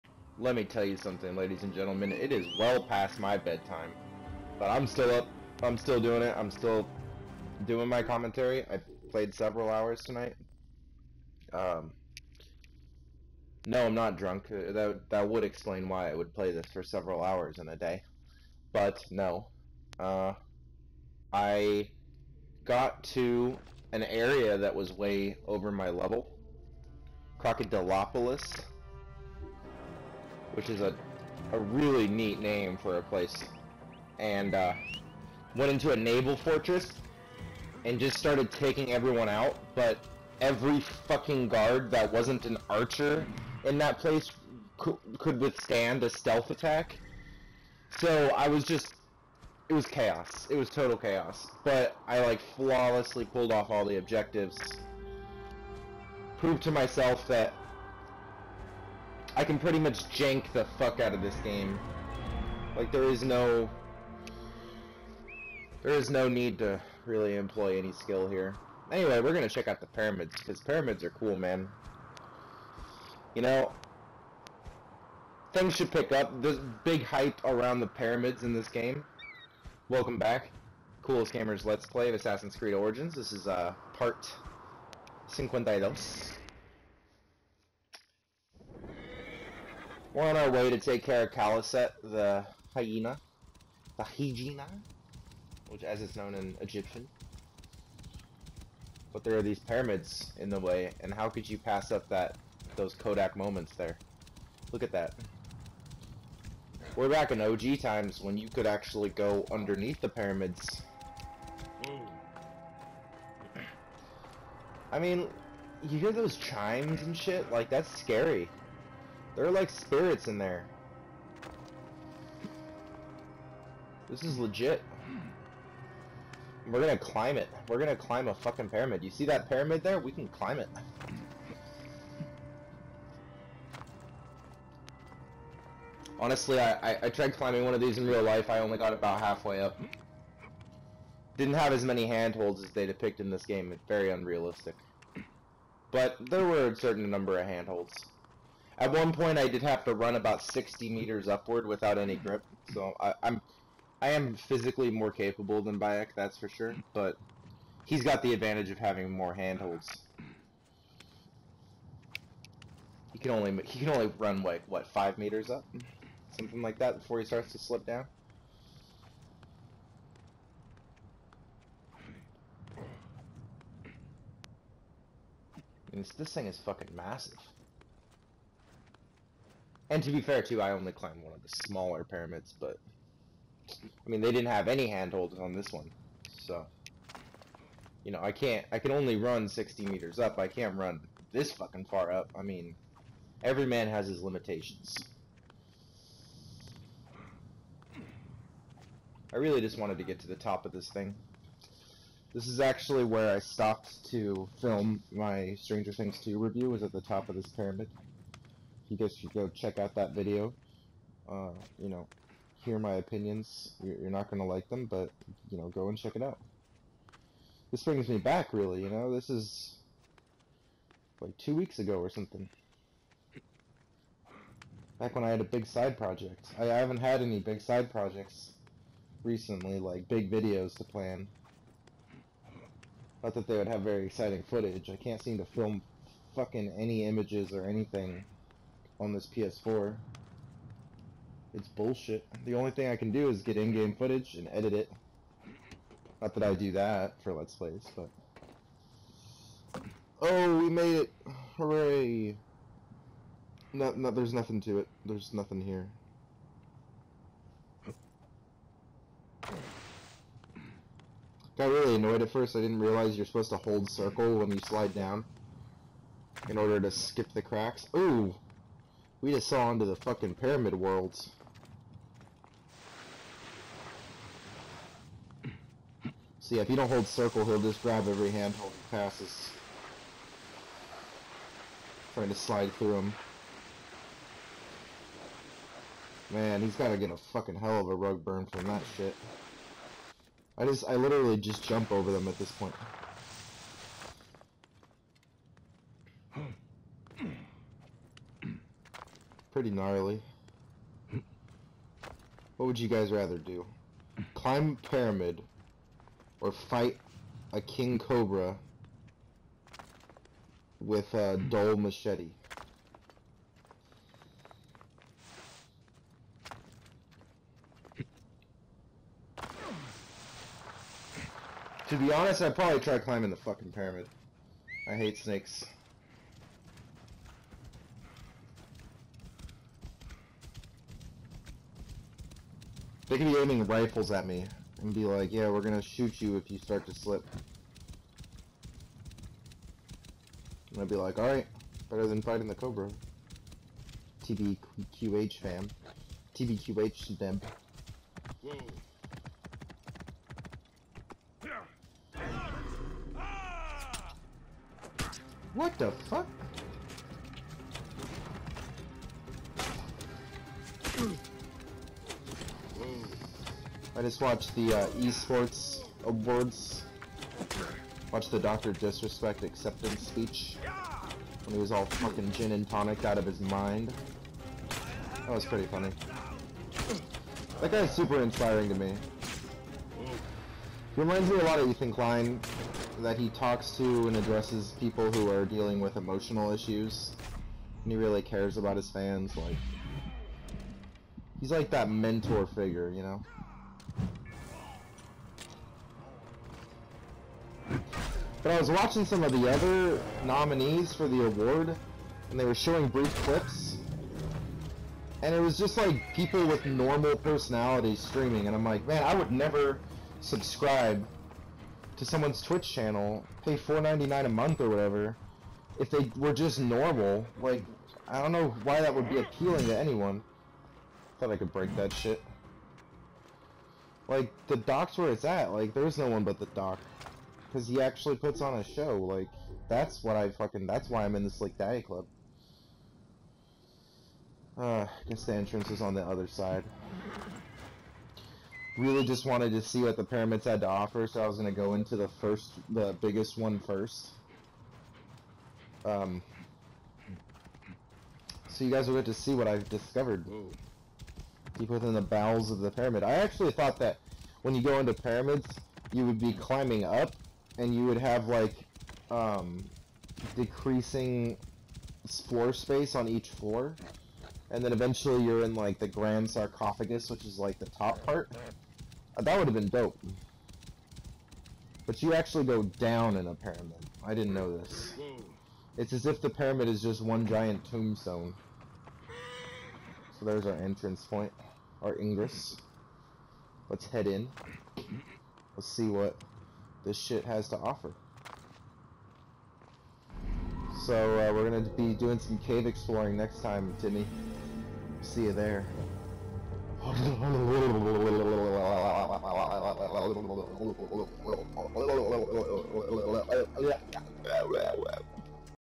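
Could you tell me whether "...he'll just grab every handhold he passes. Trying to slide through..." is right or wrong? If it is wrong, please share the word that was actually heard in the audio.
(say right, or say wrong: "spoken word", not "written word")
right.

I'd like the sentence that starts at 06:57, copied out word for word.
Like, I don't know why that would be appealing to anyone.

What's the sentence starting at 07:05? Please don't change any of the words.
Like, there's no one but the dock because he actually puts on a show.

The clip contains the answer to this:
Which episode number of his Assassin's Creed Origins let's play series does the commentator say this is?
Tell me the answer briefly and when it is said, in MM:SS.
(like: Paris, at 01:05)
52, at 01:25.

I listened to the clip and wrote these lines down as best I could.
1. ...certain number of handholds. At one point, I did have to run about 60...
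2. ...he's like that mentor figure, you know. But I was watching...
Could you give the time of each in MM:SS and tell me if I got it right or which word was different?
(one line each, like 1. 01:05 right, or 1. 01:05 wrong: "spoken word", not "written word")
1. 02:26 right
2. 06:31 right.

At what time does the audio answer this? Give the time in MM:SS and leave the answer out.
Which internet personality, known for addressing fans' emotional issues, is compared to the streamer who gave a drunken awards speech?
06:21.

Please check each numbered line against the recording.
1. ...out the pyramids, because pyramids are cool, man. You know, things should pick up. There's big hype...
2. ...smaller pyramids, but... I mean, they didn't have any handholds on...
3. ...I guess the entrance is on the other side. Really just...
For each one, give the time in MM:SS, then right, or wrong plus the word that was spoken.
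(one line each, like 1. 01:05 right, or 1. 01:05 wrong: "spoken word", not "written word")
1. 01:09 right
2. 03:01 right
3. 07:14 right.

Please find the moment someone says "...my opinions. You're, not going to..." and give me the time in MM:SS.
03:32.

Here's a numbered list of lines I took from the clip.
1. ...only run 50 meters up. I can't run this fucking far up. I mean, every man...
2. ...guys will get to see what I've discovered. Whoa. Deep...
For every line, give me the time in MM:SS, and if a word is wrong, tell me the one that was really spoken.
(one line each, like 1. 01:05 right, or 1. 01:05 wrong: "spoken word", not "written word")
1. 03:08 wrong: "60", not "50"
2. 07:28 right.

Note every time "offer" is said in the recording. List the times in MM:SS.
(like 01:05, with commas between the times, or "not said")
07:20, 08:07.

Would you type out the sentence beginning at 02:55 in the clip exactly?
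this, this thing is fucking massive.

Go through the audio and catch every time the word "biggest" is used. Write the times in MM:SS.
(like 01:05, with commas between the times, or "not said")
07:23.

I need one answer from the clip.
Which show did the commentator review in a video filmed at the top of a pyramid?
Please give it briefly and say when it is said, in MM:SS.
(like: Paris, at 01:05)
Stranger Things 2, at 03:25.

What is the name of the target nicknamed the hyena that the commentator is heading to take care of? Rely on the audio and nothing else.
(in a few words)
Khaliset.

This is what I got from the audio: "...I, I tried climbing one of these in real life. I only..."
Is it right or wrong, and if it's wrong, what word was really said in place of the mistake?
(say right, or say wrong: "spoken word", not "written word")
right.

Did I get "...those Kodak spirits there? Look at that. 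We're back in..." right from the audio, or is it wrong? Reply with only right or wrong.
wrong.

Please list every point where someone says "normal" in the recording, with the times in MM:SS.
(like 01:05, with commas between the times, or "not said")
06:46, 06:56.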